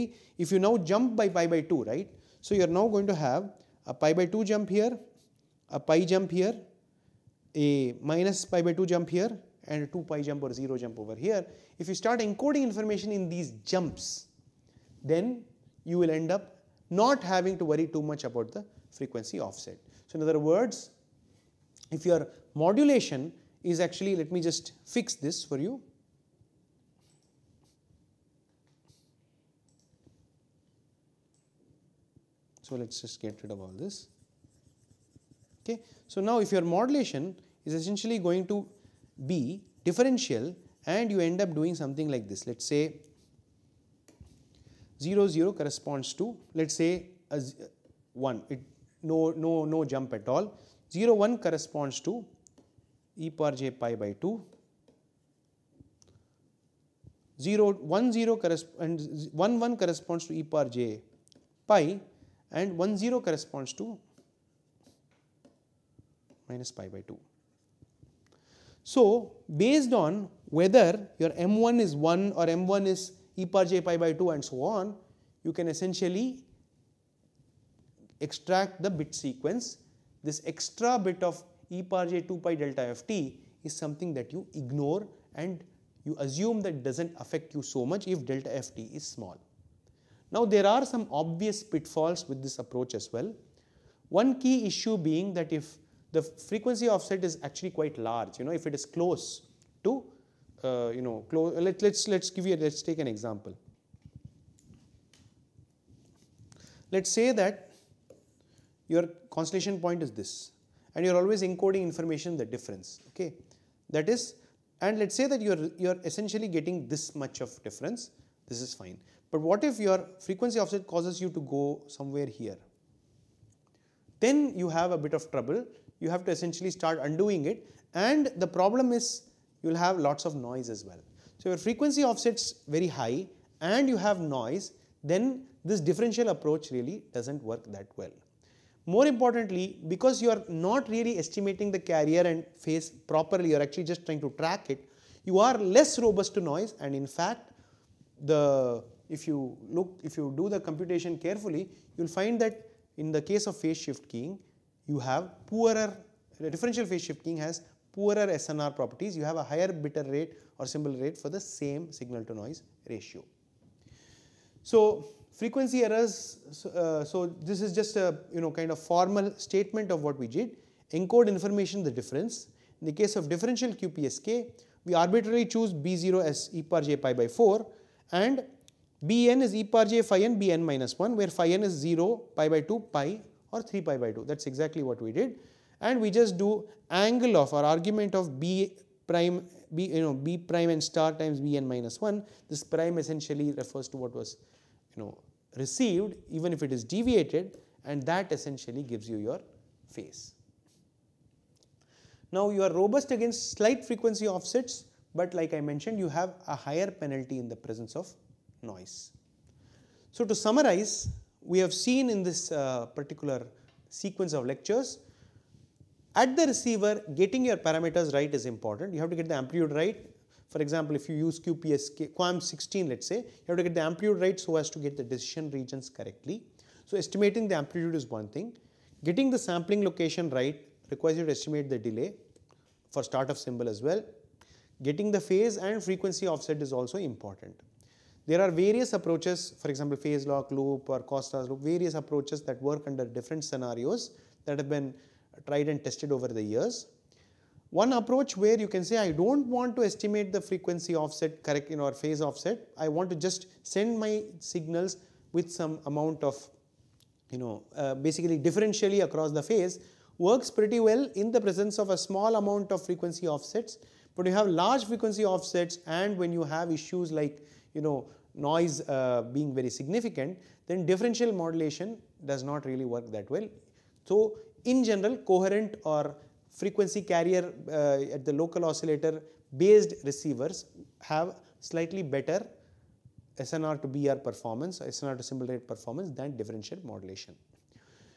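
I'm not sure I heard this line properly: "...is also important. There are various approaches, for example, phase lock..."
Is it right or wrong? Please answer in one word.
right.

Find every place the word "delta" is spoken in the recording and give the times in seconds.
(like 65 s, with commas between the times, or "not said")
82 s, 88 s.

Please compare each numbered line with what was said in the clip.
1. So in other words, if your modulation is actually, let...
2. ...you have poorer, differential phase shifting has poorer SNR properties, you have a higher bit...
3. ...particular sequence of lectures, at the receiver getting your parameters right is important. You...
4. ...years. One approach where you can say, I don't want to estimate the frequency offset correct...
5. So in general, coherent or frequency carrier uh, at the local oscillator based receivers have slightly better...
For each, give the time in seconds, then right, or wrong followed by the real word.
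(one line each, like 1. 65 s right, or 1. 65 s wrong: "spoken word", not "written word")
1. 20 s right
2. 154 s right
3. 212 s right
4. 246 s right
5. 274 s right.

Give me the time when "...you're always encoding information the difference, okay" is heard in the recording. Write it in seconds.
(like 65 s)
111 s.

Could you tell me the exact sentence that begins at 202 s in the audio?
Now you are robust against slight frequency offsets but like I mentioned you have a higher penalty in the presence of noise.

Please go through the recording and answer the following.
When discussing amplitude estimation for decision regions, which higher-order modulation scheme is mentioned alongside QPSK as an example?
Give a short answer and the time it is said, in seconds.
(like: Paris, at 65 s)
QAM 16, at 222 s.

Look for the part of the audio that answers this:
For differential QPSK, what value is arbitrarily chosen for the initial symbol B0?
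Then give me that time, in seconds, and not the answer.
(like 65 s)
176 s.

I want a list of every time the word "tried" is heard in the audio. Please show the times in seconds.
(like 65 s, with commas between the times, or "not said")
245 s.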